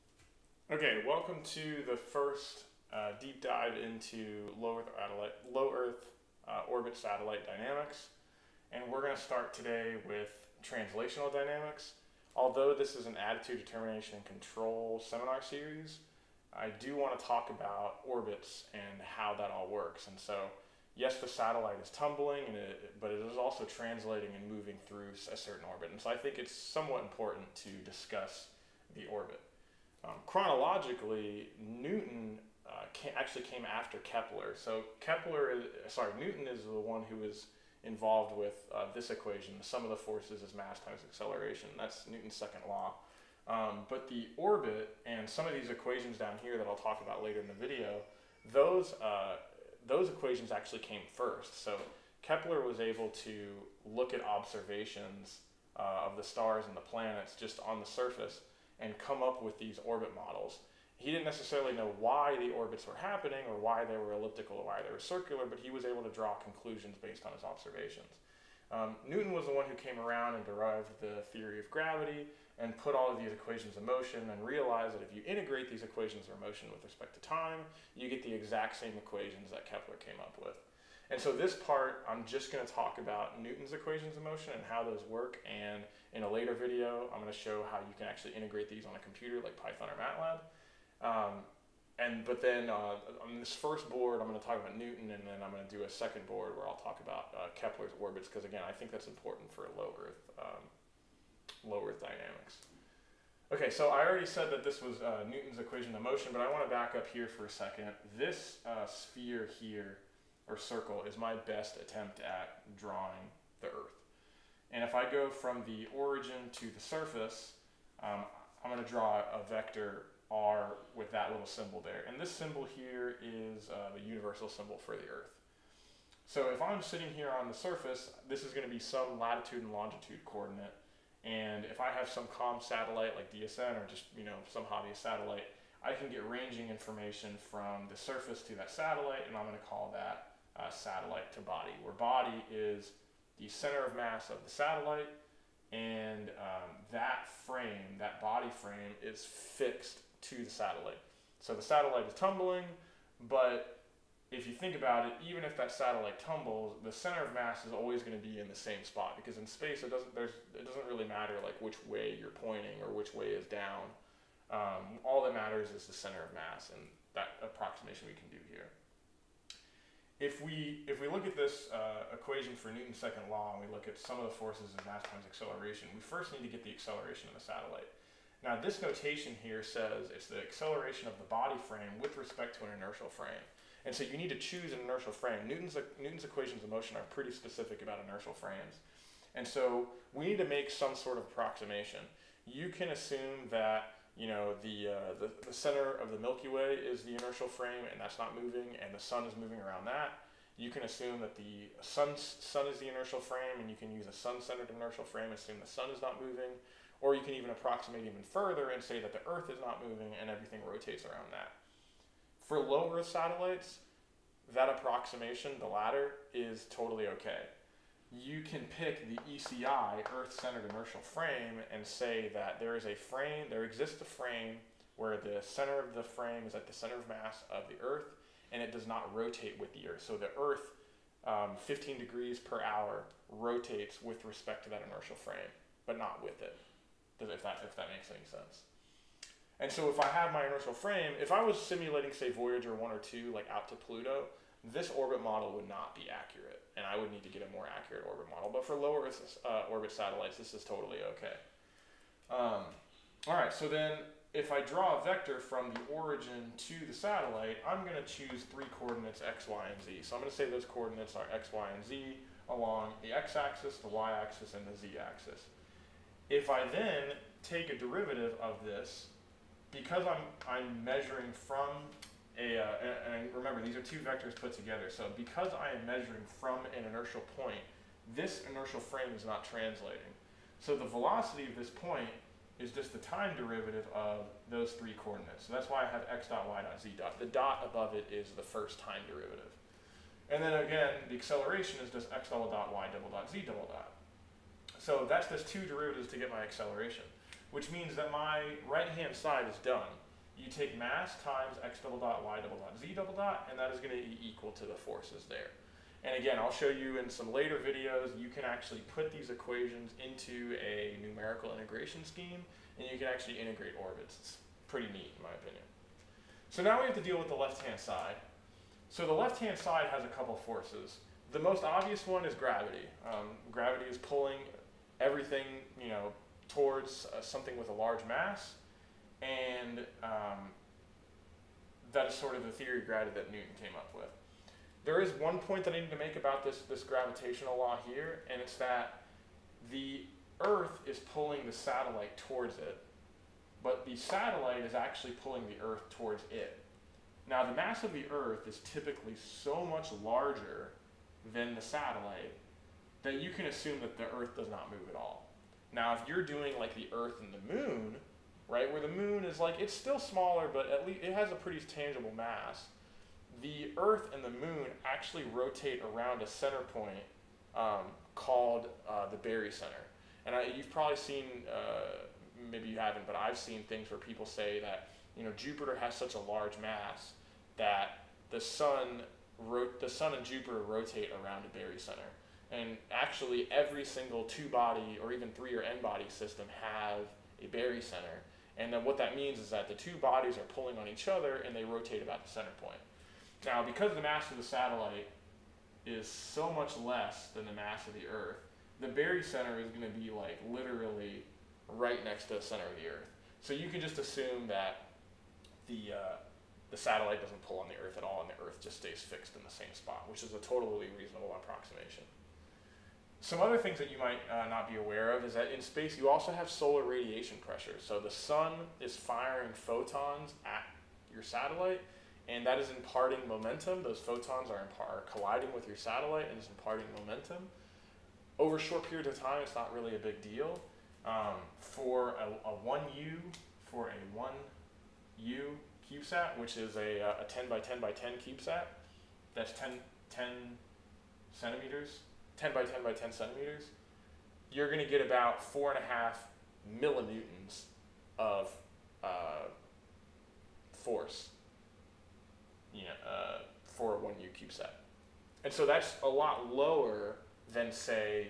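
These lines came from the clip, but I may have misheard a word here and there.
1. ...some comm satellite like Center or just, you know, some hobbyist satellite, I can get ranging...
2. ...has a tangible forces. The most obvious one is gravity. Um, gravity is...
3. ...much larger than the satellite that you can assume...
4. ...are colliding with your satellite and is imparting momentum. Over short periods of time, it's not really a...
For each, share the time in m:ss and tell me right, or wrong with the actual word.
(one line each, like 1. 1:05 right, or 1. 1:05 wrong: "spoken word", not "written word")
1. 2:12 wrong: "DSN", not "Center"
2. 5:19 wrong: "couple", not "tangible"
3. 5:49 right
4. 7:04 right.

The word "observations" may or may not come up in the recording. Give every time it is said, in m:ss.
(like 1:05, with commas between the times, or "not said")
0:54, 1:07.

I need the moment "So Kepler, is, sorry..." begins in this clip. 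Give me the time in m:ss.
0:34.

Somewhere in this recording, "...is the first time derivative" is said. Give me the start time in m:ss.
4:48.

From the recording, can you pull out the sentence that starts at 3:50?
So the Earth, um, 15 degrees per hour, rotates with respect to that inertial frame, but not with it.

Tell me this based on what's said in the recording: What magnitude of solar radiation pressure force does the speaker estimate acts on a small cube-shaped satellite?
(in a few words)
4.5 millinewtons.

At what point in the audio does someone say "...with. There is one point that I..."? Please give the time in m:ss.
5:33.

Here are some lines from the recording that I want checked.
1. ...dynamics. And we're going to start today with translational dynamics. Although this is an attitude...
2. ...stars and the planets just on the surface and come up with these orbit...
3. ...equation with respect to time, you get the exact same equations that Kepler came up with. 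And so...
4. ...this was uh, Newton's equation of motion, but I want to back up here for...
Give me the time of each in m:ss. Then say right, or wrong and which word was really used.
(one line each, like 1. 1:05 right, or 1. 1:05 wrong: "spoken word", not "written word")
1. 0:07 right
2. 0:56 right
3. 1:16 wrong: "motion", not "equation"
4. 1:44 right.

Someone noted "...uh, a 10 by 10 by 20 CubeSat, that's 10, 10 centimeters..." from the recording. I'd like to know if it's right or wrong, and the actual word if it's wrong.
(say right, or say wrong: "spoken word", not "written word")
wrong: "10", not "20".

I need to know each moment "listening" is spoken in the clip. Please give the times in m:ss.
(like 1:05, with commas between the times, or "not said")
not said.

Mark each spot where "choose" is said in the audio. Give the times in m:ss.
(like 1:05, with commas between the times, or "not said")
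3:04, 4:18.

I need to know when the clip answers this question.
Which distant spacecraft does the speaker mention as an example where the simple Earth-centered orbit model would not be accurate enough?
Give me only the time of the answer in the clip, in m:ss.
4:02.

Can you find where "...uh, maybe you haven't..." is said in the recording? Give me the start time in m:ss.
6:11.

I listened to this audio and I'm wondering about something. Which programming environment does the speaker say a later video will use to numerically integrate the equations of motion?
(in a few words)
Python.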